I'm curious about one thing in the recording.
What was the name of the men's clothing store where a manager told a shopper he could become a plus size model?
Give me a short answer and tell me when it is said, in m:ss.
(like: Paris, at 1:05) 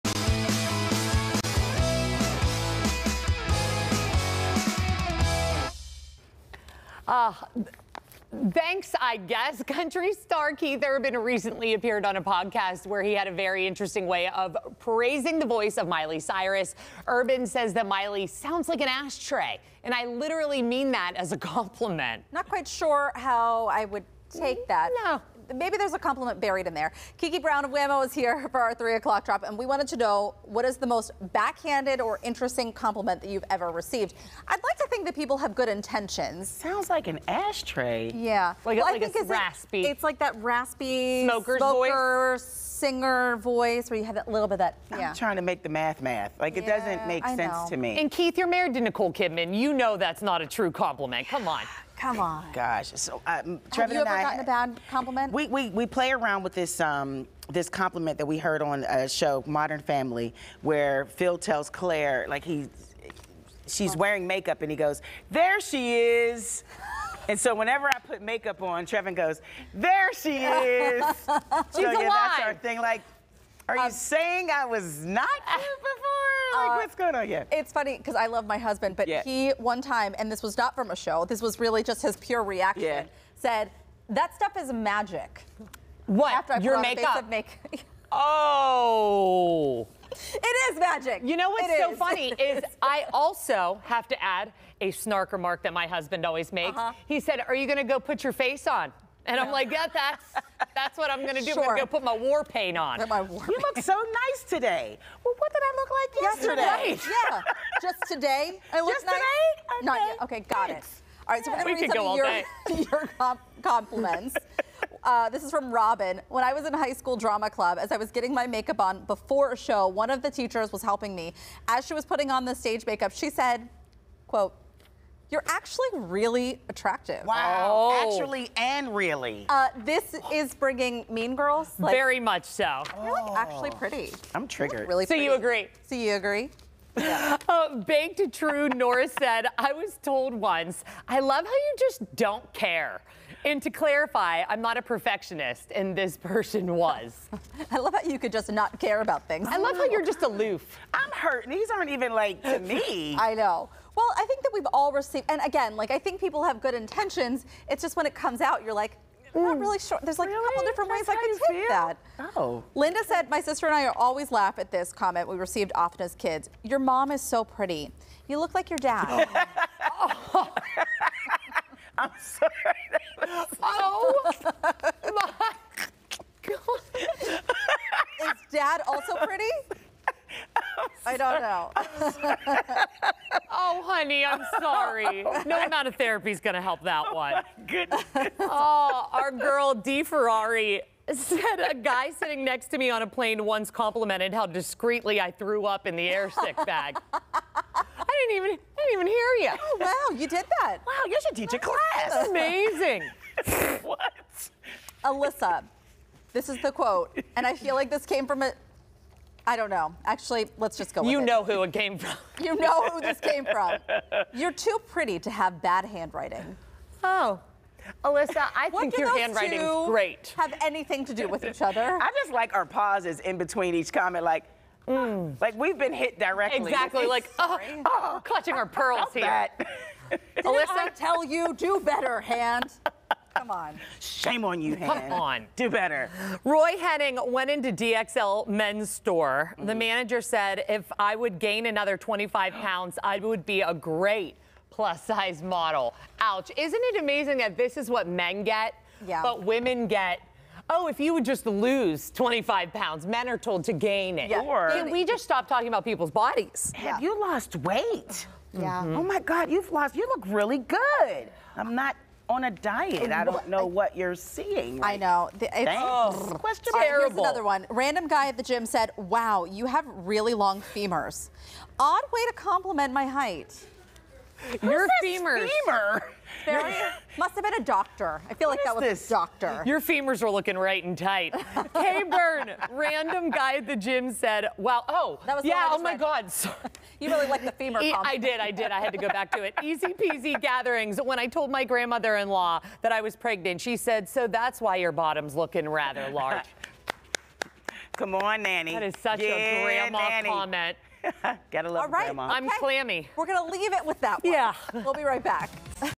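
DXL, at 3:57.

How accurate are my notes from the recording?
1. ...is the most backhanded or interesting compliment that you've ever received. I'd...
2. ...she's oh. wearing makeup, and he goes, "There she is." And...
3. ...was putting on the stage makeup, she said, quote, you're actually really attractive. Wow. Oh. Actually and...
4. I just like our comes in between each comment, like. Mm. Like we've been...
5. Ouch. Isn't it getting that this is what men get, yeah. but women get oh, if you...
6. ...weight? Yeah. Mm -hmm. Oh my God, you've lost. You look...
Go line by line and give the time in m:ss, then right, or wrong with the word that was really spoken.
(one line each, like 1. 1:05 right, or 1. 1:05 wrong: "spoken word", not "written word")
1. 0:30 right
2. 1:03 right
3. 2:01 right
4. 3:41 wrong: "pauses", not "comes"
5. 4:06 wrong: "amazing", not "getting"
6. 4:17 right.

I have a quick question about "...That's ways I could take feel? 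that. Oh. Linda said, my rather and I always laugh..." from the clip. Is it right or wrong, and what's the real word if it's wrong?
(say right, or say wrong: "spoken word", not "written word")
wrong: "sister", not "rather".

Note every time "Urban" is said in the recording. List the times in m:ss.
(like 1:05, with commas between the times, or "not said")
0:10, 0:17.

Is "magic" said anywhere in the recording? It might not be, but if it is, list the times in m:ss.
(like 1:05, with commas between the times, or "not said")
1:24, 1:30.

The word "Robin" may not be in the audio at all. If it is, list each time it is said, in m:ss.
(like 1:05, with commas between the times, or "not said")
1:55.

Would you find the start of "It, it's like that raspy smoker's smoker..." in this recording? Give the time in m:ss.
0:39.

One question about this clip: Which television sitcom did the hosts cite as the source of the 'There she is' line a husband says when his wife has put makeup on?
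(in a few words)
Modern Family.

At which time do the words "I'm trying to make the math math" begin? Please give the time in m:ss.
0:45.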